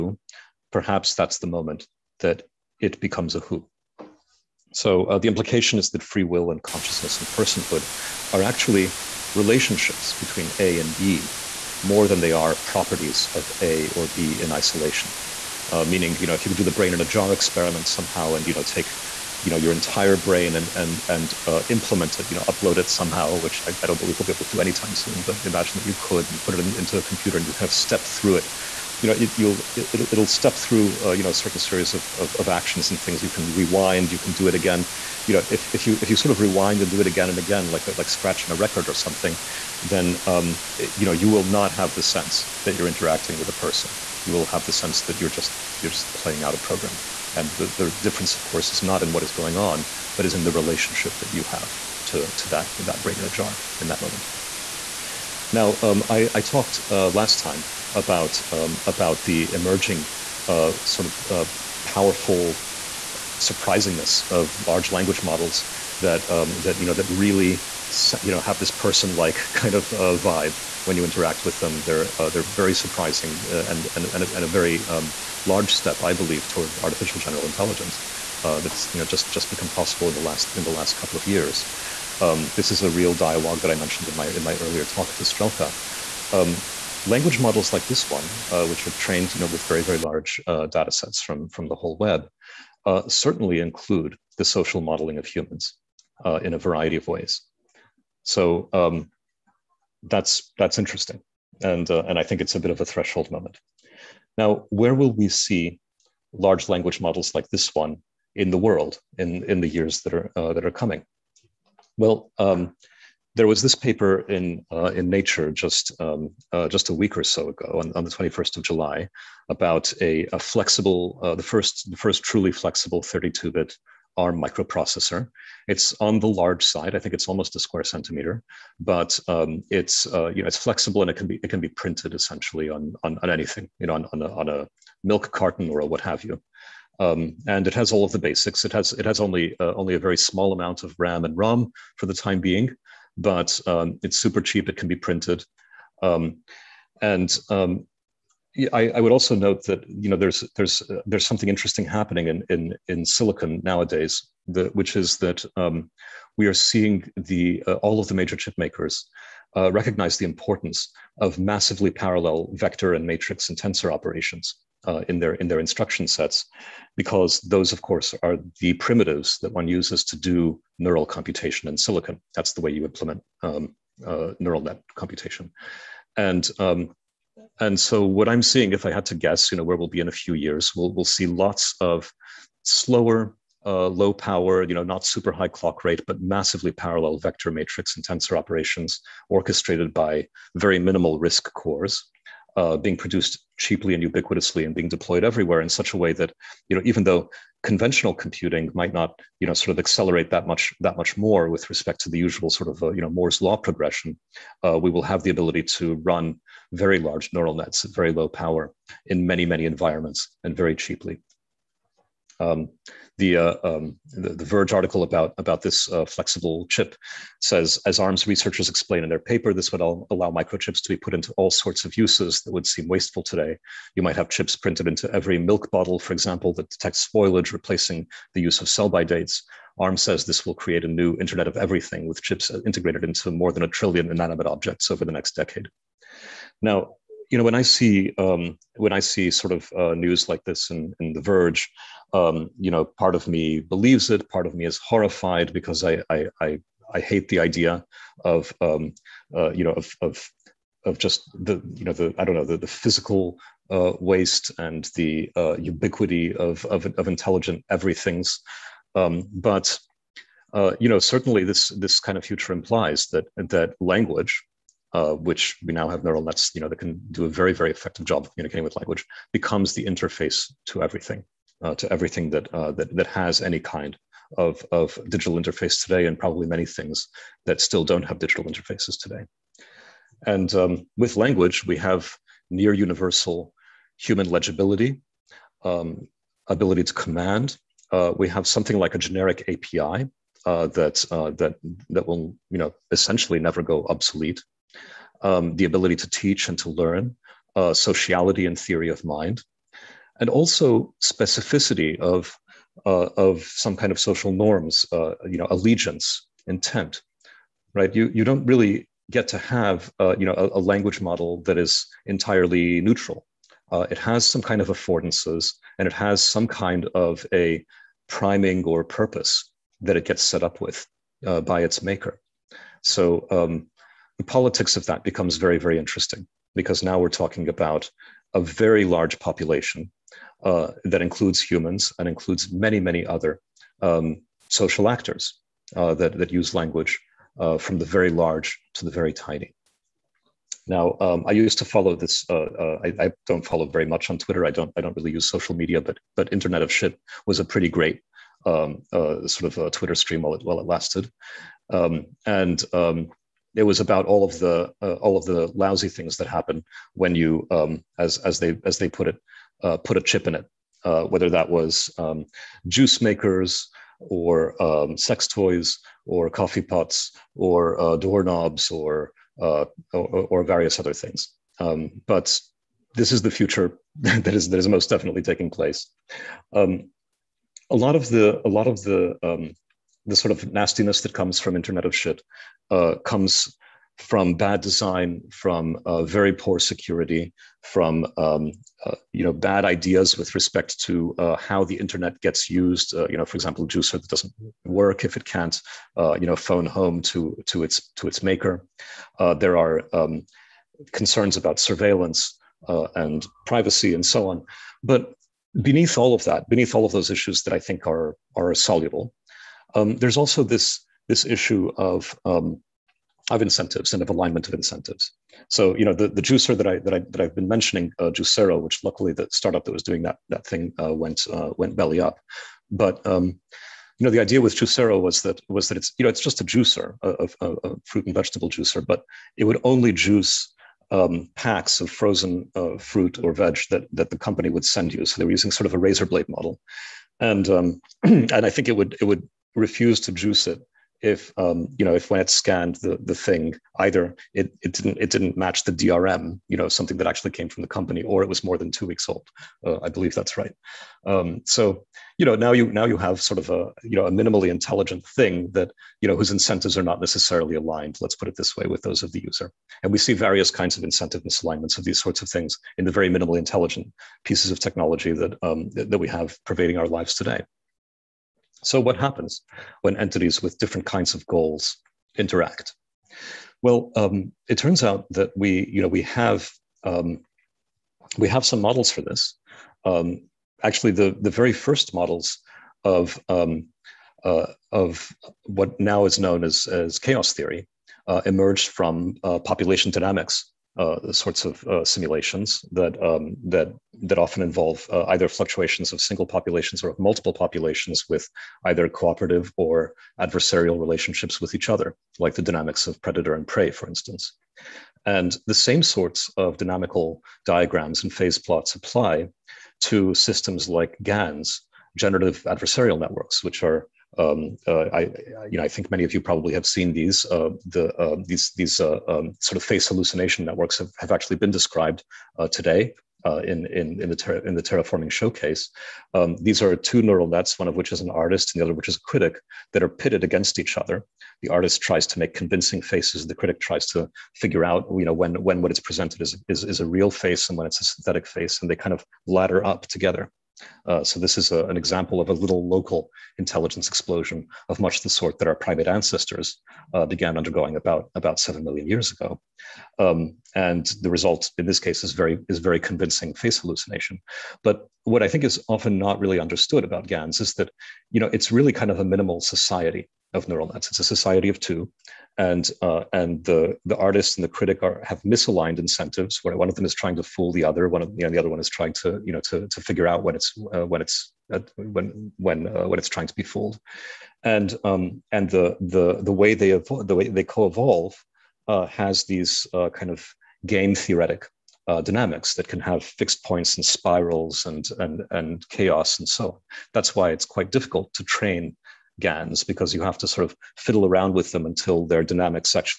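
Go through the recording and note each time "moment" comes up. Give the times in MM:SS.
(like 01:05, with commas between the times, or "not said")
00:01, 00:54, 01:43.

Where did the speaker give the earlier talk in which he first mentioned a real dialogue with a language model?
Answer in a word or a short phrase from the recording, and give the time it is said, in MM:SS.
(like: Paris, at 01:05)
Strelka, at 01:25.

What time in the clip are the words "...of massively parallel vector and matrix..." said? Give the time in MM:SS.
02:41.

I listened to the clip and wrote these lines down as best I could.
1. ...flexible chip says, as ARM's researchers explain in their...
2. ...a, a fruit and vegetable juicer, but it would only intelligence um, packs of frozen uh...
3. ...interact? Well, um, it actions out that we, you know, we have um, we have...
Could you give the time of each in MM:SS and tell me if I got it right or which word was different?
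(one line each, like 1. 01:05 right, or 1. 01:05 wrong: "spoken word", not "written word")
1. 03:36 right
2. 07:07 wrong: "juice", not "intelligence"
3. 07:52 wrong: "turns", not "actions".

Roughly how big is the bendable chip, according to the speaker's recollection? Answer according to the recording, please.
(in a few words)
a square centimeter.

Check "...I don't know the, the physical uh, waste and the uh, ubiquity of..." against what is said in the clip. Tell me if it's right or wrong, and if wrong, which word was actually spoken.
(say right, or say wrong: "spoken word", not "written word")
right.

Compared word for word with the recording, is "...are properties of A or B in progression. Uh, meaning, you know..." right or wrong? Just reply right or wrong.
wrong.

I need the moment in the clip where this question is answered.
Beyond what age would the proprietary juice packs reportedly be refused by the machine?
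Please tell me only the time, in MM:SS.
07:28.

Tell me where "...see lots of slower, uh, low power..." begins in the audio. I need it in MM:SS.
03:01.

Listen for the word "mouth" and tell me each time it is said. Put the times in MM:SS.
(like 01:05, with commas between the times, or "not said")
not said.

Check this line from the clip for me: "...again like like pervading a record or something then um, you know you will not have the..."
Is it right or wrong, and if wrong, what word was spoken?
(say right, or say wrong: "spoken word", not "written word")
wrong: "scratching", not "pervading".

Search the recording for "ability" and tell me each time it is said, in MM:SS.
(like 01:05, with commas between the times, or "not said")
03:25, 04:46, 04:55.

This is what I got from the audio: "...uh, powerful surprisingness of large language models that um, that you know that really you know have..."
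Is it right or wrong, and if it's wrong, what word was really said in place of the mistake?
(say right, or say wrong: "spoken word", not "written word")
right.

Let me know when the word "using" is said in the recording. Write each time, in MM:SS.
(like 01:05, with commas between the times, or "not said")
07:15.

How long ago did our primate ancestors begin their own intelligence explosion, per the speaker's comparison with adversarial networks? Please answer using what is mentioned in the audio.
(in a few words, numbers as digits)
7 million years.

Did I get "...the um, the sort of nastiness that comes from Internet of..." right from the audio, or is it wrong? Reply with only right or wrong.
right.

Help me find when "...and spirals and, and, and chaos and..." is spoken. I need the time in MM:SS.
09:43.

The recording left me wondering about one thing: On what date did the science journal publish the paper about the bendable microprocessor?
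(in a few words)
21st of July.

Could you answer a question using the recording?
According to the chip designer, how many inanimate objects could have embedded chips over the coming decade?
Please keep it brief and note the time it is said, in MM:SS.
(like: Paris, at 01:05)
more than a trillion, at 03:53.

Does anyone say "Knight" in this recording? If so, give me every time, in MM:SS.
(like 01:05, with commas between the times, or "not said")
not said.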